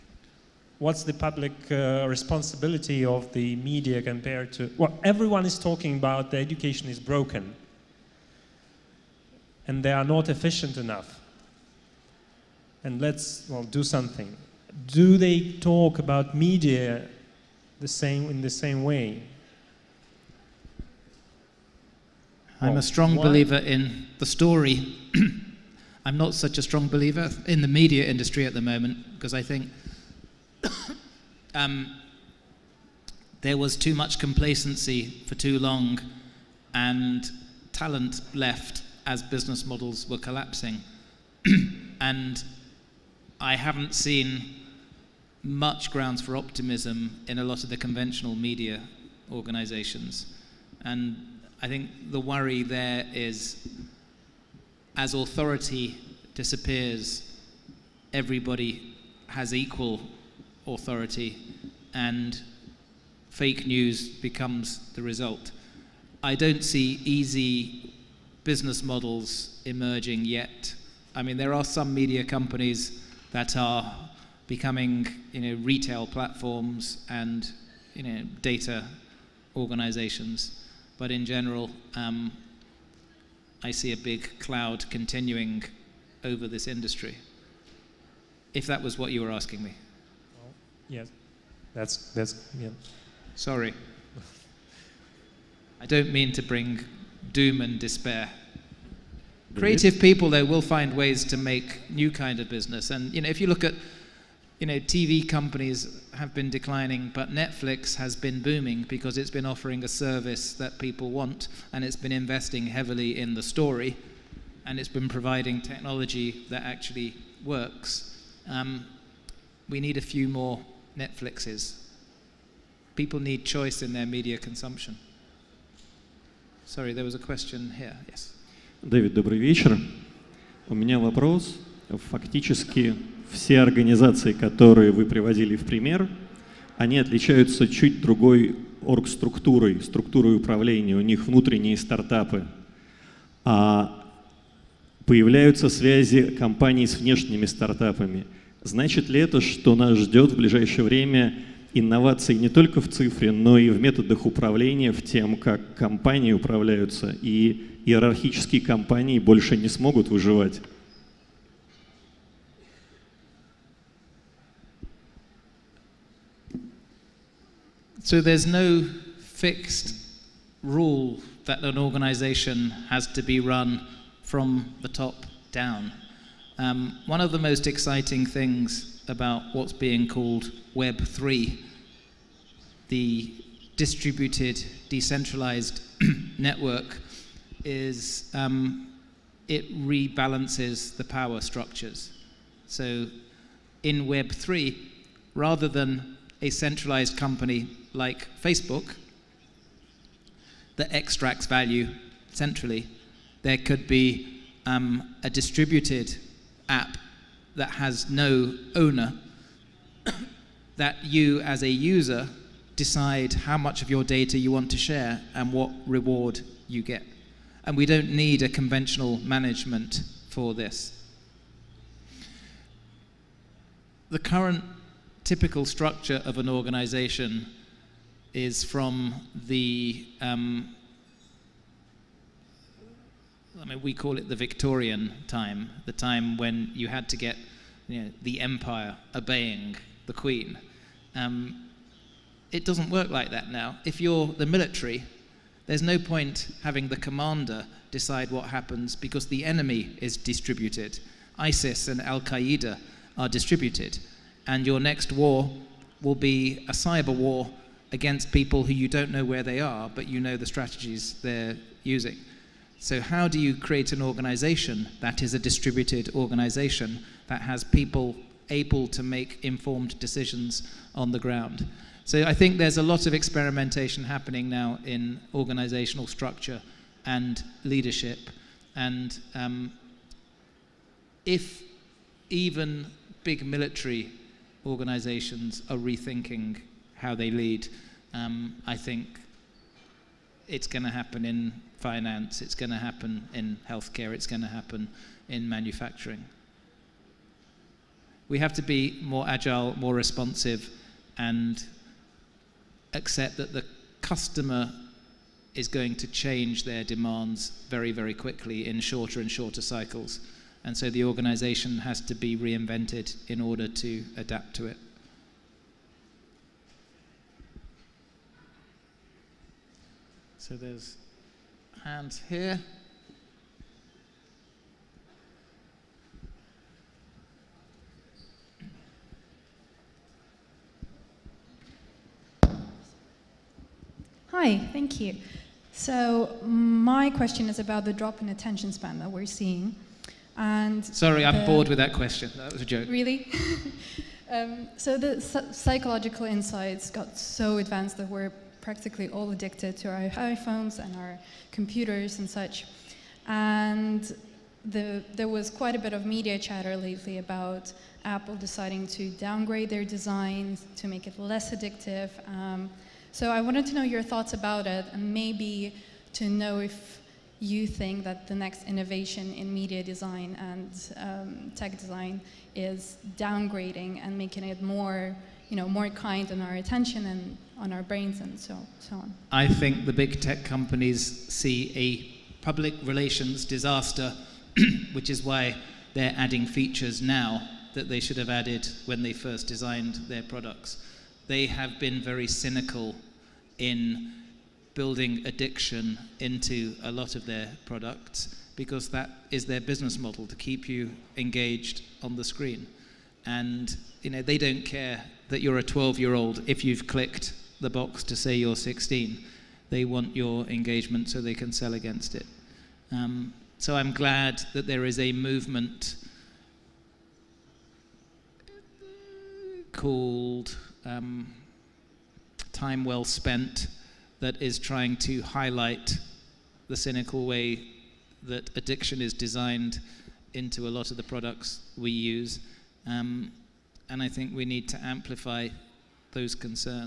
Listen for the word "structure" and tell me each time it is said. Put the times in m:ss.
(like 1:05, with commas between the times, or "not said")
3:11, 3:45, 4:36.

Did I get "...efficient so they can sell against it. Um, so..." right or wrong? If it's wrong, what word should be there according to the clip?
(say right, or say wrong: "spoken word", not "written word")
wrong: "engagement", not "efficient".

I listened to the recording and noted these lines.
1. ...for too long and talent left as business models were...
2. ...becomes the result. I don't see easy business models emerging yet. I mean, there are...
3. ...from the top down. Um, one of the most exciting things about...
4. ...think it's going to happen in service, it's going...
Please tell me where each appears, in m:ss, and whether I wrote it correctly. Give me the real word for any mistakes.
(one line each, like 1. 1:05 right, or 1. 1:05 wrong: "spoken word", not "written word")
1. 0:35 right
2. 1:04 right
3. 2:54 right
4. 4:48 wrong: "finance", not "service".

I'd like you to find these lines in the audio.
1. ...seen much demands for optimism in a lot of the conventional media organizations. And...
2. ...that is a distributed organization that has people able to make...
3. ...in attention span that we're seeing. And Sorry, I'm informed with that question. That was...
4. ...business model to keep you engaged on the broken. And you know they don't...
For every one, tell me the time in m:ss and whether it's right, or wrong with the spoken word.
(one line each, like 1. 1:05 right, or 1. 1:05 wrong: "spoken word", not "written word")
1. 0:43 wrong: "grounds", not "demands"
2. 4:25 right
3. 5:38 wrong: "bored", not "informed"
4. 6:39 wrong: "screen", not "broken".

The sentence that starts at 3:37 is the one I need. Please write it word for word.
And we don't need a conventional management for this.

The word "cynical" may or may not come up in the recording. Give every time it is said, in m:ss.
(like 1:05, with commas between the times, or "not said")
6:32, 7:06.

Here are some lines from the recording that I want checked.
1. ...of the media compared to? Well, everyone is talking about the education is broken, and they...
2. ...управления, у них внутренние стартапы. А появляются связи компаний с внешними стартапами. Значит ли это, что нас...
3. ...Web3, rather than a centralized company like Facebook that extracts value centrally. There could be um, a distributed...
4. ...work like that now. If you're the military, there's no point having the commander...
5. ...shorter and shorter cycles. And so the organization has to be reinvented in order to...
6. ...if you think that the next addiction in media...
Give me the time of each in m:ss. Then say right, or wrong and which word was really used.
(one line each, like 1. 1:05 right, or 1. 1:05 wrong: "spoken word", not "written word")
1. 0:03 right
2. 2:20 right
3. 3:14 right
4. 4:02 right
5. 5:08 right
6. 6:06 wrong: "innovation", not "addiction".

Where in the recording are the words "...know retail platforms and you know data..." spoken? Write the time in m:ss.
1:15.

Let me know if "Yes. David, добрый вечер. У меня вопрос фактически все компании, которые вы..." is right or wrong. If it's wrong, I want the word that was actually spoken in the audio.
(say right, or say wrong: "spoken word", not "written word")
wrong: "организации", not "компании".